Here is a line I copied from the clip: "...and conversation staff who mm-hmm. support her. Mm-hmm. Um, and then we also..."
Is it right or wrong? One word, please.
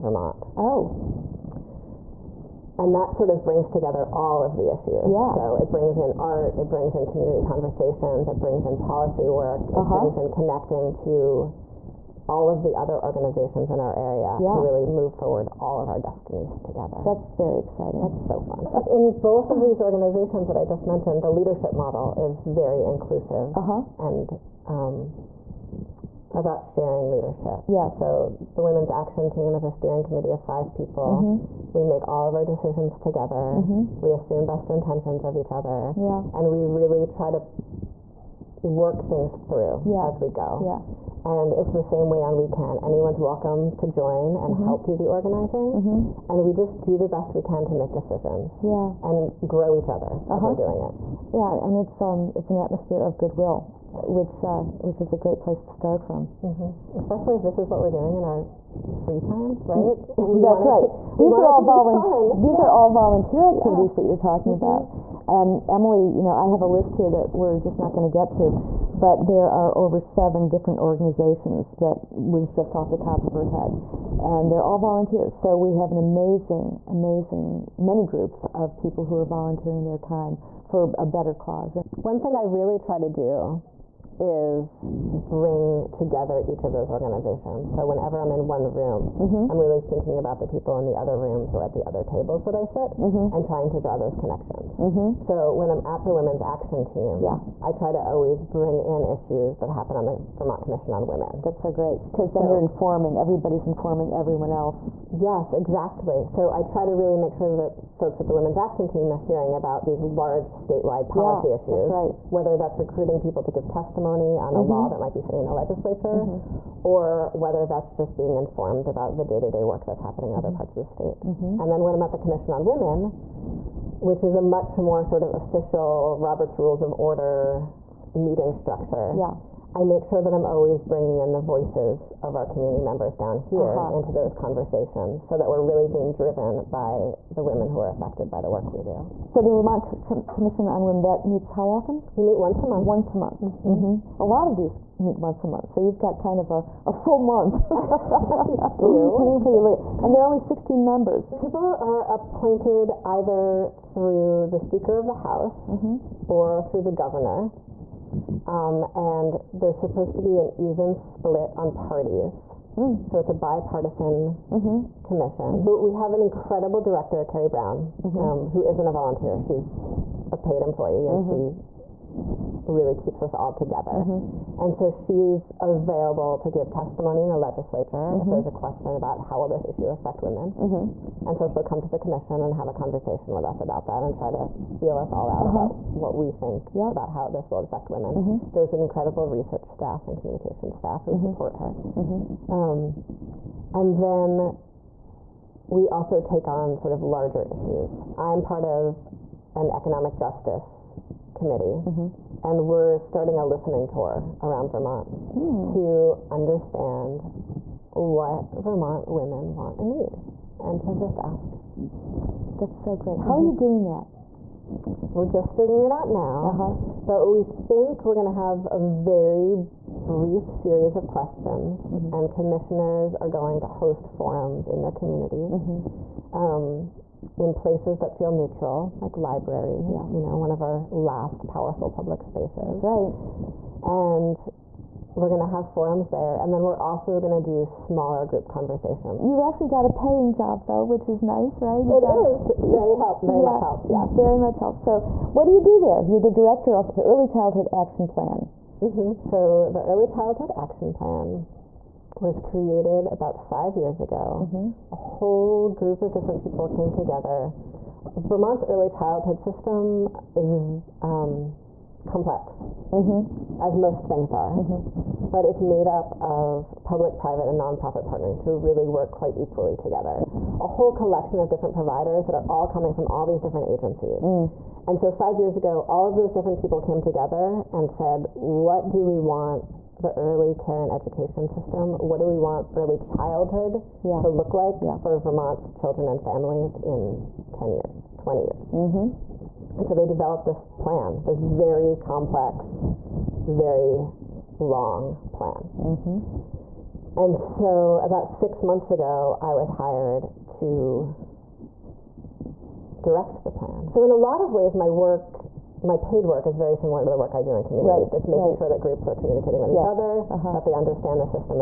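wrong.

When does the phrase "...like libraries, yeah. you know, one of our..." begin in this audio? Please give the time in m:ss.
3:48.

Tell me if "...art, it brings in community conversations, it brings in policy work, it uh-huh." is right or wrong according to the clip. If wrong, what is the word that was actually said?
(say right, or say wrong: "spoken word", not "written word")
right.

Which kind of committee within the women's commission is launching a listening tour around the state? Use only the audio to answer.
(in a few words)
economic justice committee.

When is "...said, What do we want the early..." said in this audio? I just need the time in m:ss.
4:37.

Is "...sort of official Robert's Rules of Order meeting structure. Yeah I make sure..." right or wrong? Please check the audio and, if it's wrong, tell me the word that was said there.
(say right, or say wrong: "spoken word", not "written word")
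right.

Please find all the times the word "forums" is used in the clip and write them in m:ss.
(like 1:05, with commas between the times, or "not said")
3:44, 3:55.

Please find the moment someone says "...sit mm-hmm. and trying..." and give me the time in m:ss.
1:32.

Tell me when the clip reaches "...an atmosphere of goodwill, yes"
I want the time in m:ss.
0:52.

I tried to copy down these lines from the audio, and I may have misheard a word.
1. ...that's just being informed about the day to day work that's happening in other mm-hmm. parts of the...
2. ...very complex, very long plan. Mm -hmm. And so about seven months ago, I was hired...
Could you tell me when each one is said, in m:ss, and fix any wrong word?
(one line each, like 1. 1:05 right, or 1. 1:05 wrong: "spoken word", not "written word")
1. 1:57 right
2. 4:51 wrong: "six", not "seven".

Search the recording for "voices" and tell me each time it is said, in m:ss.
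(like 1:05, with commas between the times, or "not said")
2:11.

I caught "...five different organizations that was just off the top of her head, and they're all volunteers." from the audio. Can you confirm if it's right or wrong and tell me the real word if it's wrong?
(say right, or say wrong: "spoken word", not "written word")
wrong: "seven", not "five".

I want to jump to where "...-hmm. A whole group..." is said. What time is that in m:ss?
4:14.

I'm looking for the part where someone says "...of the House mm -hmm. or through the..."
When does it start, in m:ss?
2:34.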